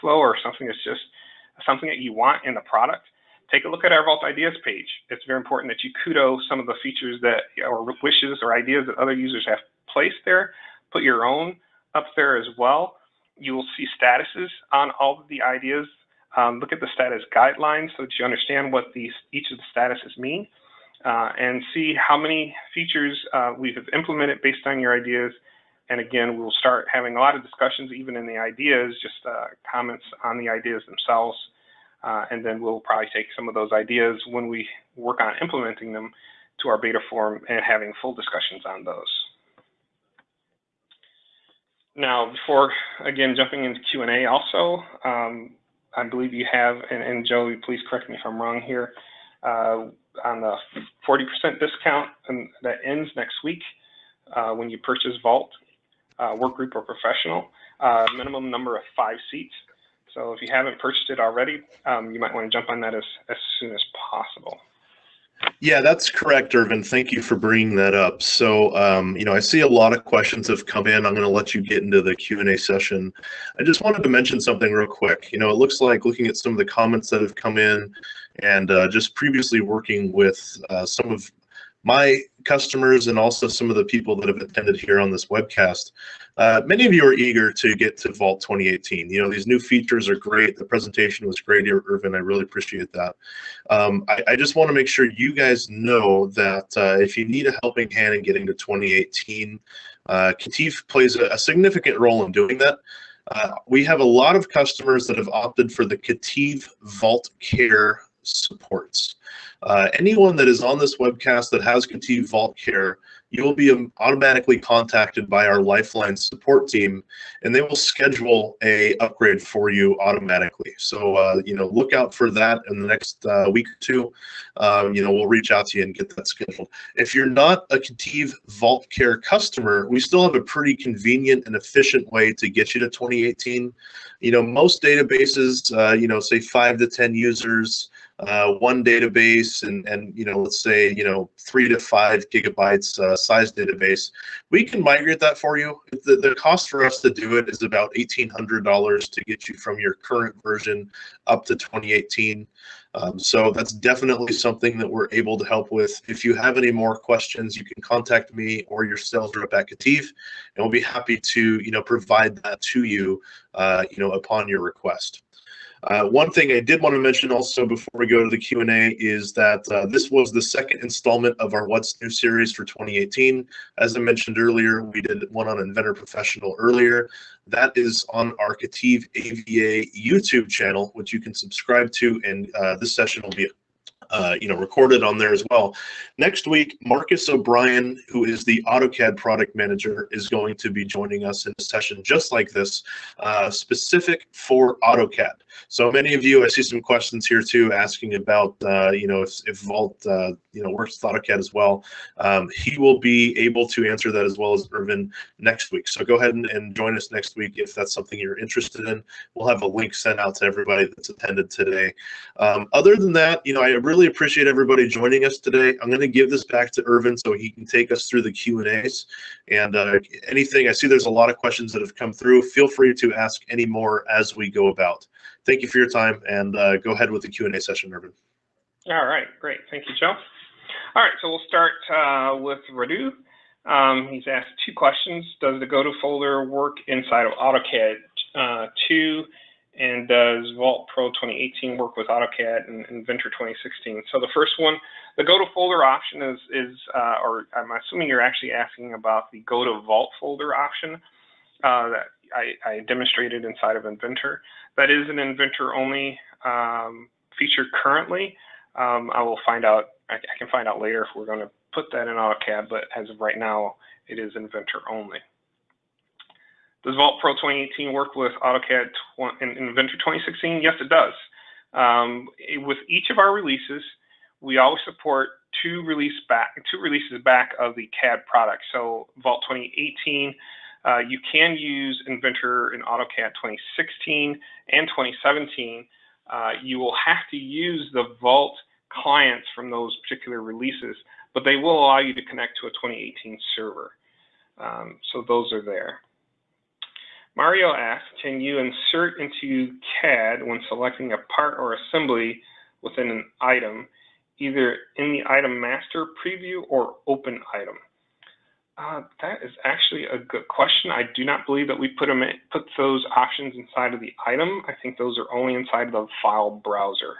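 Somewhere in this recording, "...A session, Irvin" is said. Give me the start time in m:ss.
3:47.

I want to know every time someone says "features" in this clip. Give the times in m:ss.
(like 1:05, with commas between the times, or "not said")
0:06, 0:22, 1:29, 4:17.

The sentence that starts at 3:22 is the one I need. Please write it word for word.
Um, he will be able to answer that as well as Irvin next week.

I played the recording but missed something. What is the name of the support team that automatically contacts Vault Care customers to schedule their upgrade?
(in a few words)
Lifeline.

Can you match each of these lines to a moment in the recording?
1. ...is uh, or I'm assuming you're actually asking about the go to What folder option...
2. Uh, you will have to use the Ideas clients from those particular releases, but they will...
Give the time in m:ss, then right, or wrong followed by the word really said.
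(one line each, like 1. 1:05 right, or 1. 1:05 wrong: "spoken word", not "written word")
1. 4:06 wrong: "Vault", not "What"
2. 4:46 wrong: "Vault", not "Ideas".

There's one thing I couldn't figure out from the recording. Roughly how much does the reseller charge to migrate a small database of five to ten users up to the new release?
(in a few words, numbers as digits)
$1800.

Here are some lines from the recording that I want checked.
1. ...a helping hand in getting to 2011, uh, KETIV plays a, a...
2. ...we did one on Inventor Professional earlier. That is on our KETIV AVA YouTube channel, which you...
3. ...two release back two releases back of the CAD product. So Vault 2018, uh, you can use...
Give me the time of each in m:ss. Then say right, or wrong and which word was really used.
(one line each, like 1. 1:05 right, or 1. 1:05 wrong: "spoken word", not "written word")
1. 1:37 wrong: "2018", not "2011"
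2. 2:54 right
3. 4:35 right.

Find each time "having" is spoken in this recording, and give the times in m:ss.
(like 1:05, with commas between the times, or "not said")
0:26, 0:37.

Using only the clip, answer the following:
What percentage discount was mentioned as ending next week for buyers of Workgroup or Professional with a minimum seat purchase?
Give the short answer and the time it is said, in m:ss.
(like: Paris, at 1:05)
40%, at 0:51.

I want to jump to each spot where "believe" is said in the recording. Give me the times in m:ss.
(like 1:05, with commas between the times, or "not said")
0:46, 5:11.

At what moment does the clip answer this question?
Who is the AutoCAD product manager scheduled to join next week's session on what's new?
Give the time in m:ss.
3:06.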